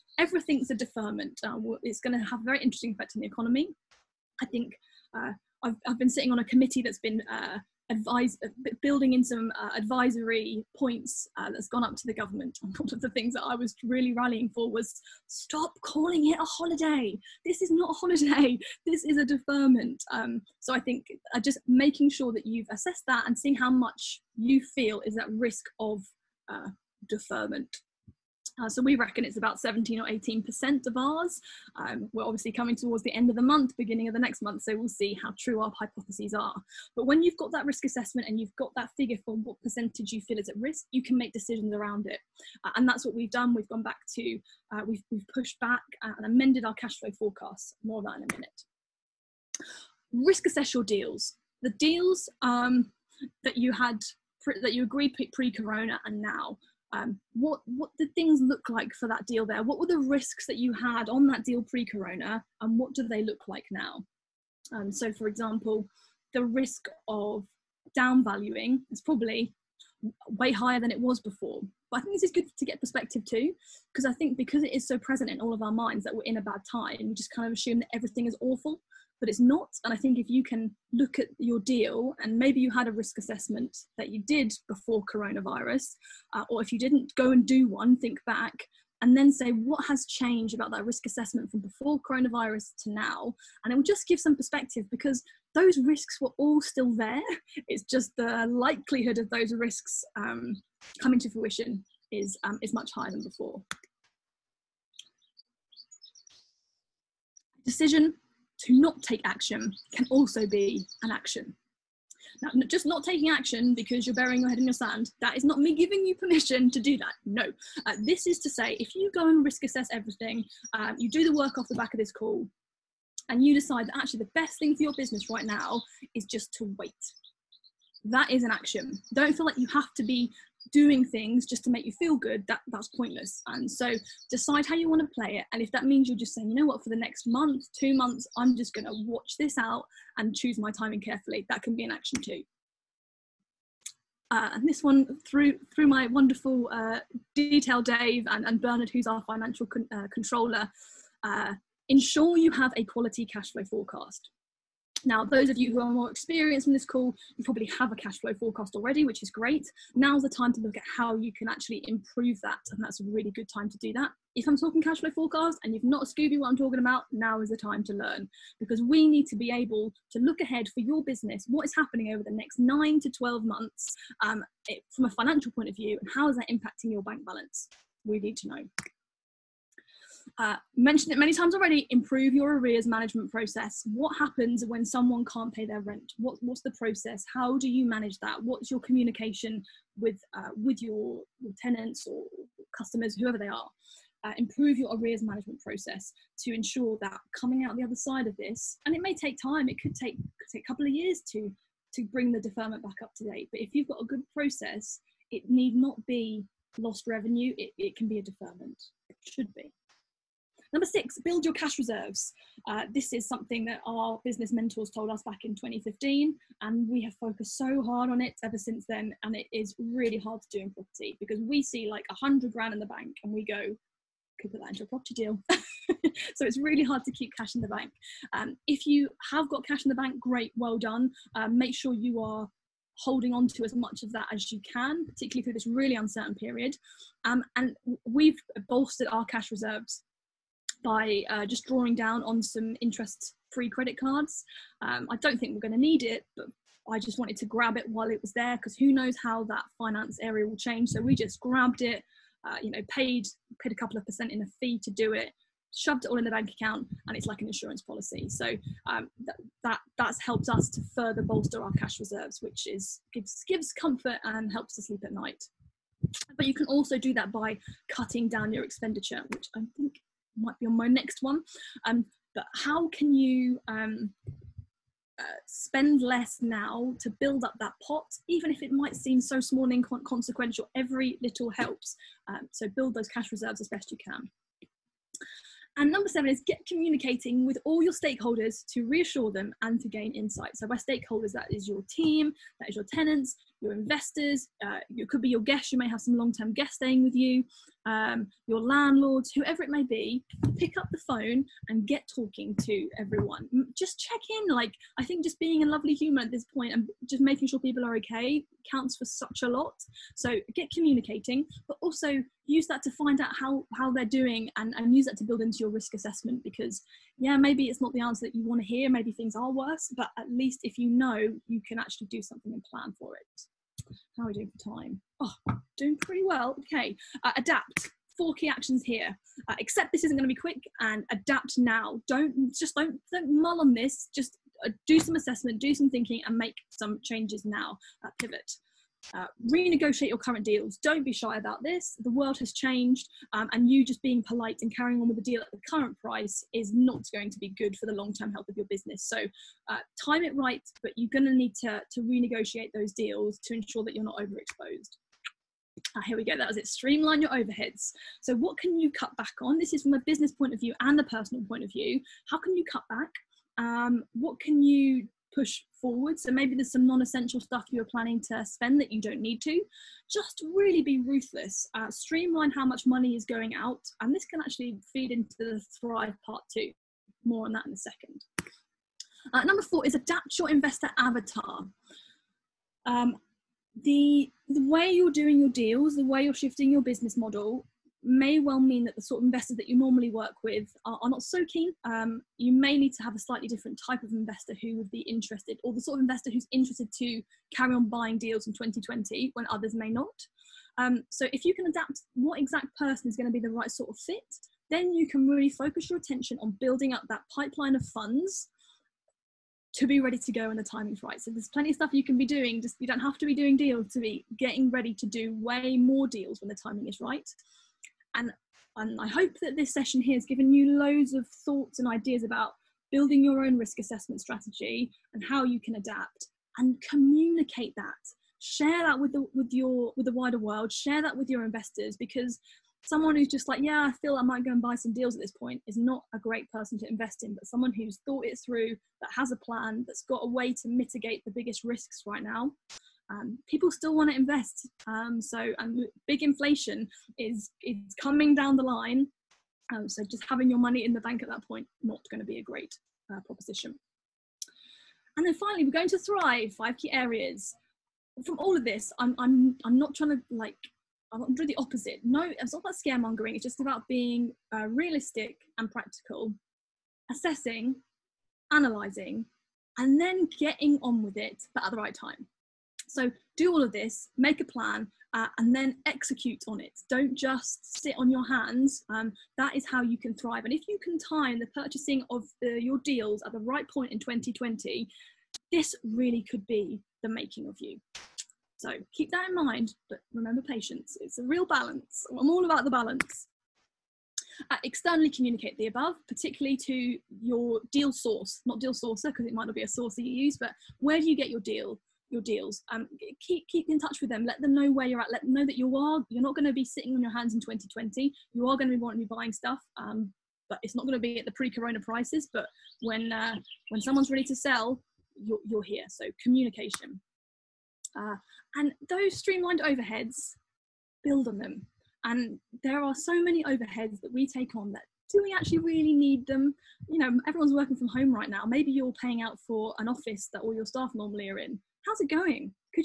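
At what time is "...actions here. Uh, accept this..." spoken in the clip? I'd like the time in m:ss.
5:28.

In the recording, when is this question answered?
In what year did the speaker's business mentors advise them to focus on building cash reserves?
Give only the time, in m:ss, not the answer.
3:35.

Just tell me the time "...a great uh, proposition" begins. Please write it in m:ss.
7:32.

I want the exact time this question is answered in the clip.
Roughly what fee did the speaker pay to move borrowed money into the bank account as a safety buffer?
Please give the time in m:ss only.
4:13.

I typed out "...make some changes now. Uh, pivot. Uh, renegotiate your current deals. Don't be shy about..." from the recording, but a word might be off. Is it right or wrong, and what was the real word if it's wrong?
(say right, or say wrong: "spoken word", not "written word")
right.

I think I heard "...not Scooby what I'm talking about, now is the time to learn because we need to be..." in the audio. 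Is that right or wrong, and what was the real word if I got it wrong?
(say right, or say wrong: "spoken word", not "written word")
right.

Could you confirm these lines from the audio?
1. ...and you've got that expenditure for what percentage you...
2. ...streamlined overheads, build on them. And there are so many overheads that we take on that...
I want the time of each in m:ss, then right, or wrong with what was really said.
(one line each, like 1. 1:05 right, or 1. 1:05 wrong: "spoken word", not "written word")
1. 0:38 wrong: "figure", not "expenditure"
2. 8:39 right.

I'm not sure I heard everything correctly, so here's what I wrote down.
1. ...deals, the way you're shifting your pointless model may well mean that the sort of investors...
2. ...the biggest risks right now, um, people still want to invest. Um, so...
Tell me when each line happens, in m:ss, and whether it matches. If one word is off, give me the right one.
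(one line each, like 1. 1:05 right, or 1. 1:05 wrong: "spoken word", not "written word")
1. 6:25 wrong: "business", not "pointless"
2. 7:21 right.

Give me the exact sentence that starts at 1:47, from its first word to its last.
Decision to not take action can also be an action.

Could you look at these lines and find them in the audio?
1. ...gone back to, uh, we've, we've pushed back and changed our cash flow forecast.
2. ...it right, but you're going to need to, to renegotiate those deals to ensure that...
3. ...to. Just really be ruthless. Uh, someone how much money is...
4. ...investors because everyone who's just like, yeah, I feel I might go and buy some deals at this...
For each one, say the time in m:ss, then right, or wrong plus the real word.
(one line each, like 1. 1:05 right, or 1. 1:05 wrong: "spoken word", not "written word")
1. 0:43 wrong: "amended", not "changed"
2. 5:50 right
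3. 6:09 wrong: "streamline", not "someone"
4. 7:11 wrong: "someone", not "everyone".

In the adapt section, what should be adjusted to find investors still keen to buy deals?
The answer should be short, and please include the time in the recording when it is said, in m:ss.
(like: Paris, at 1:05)
Investor avatar, at 6:20.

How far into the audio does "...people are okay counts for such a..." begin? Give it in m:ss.
5:07.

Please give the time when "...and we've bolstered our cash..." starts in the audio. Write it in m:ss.
3:57.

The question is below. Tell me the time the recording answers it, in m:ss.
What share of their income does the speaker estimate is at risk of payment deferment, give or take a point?
0:29.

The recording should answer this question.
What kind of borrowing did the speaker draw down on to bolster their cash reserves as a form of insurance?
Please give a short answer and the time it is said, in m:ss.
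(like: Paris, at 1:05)
Interest-free credit cards, at 4:02.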